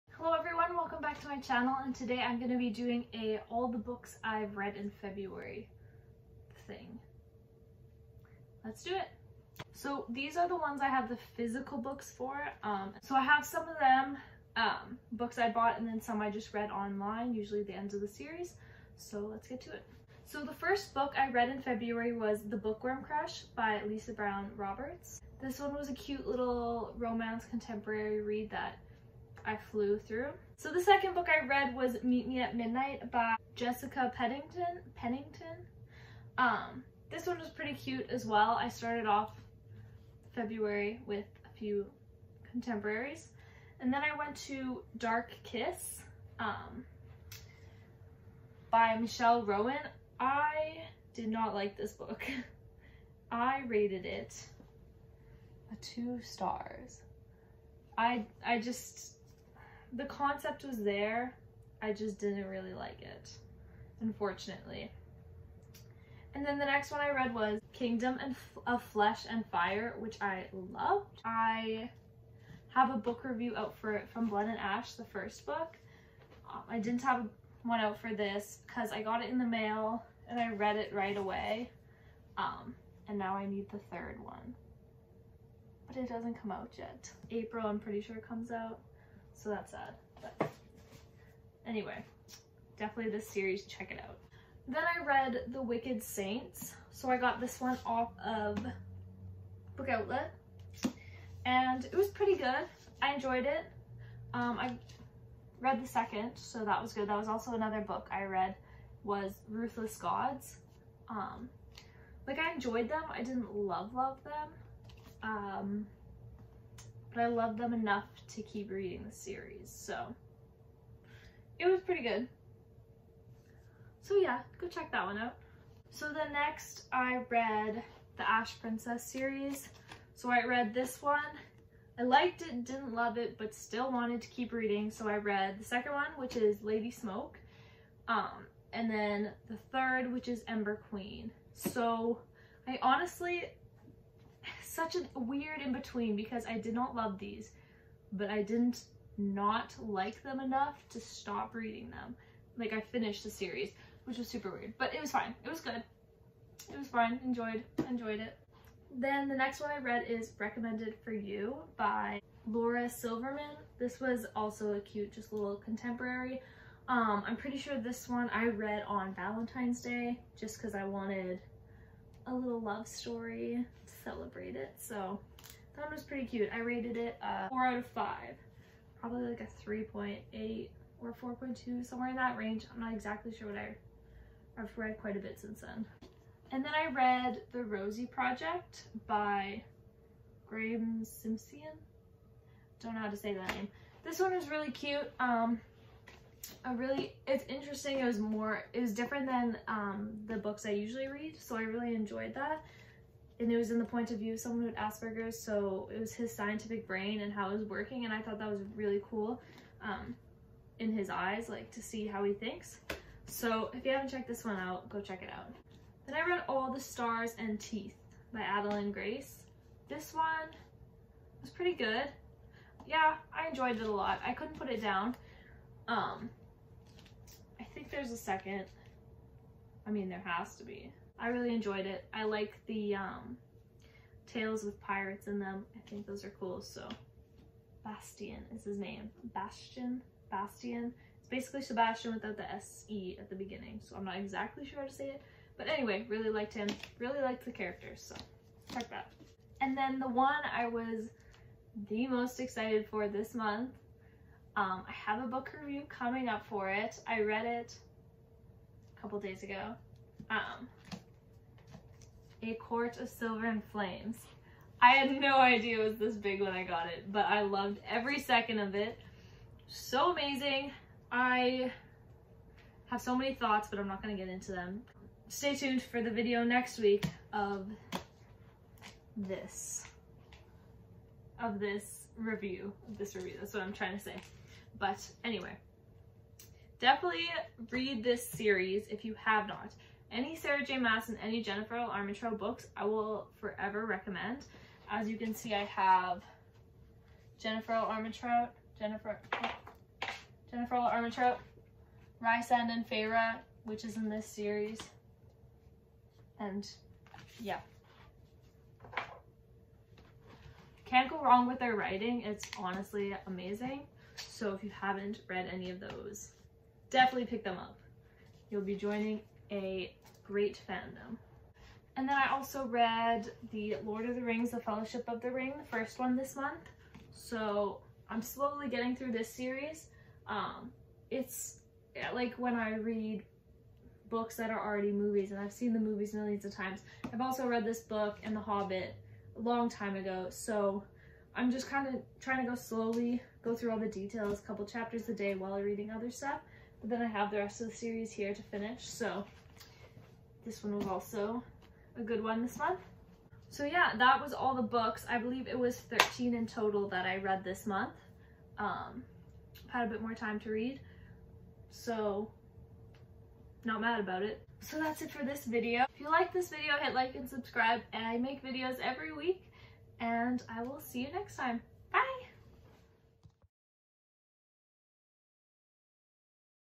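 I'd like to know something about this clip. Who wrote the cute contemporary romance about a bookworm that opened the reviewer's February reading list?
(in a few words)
Lisa Brown Roberts.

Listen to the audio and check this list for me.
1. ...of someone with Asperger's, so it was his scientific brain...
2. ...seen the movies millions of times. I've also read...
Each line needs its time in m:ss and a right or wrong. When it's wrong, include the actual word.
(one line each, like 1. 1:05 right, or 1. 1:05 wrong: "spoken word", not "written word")
1. 3:24 right
2. 5:35 right.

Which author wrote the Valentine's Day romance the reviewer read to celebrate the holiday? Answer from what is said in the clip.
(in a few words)
Laura Silverman.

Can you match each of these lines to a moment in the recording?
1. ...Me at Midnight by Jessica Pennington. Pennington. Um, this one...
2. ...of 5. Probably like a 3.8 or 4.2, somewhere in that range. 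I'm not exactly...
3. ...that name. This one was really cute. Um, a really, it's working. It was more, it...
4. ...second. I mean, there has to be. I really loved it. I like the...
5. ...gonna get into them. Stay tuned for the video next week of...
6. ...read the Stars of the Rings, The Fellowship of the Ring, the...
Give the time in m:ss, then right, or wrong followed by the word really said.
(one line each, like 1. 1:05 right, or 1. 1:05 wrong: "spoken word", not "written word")
1. 0:32 right
2. 2:57 right
3. 3:13 wrong: "interesting", not "working"
4. 3:48 wrong: "enjoyed", not "loved"
5. 4:34 right
6. 5:22 wrong: "Lord", not "Stars".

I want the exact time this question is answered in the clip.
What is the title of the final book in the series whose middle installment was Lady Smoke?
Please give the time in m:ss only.
2:20.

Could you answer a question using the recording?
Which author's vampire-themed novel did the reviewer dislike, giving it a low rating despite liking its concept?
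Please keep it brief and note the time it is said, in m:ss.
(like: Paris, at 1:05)
Michelle Rowan, at 0:48.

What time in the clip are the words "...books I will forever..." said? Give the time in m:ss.
4:52.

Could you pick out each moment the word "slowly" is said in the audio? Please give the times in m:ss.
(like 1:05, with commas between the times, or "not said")
5:28, 5:42.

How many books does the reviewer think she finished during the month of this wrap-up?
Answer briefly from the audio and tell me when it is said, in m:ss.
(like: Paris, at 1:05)
13, at 5:55.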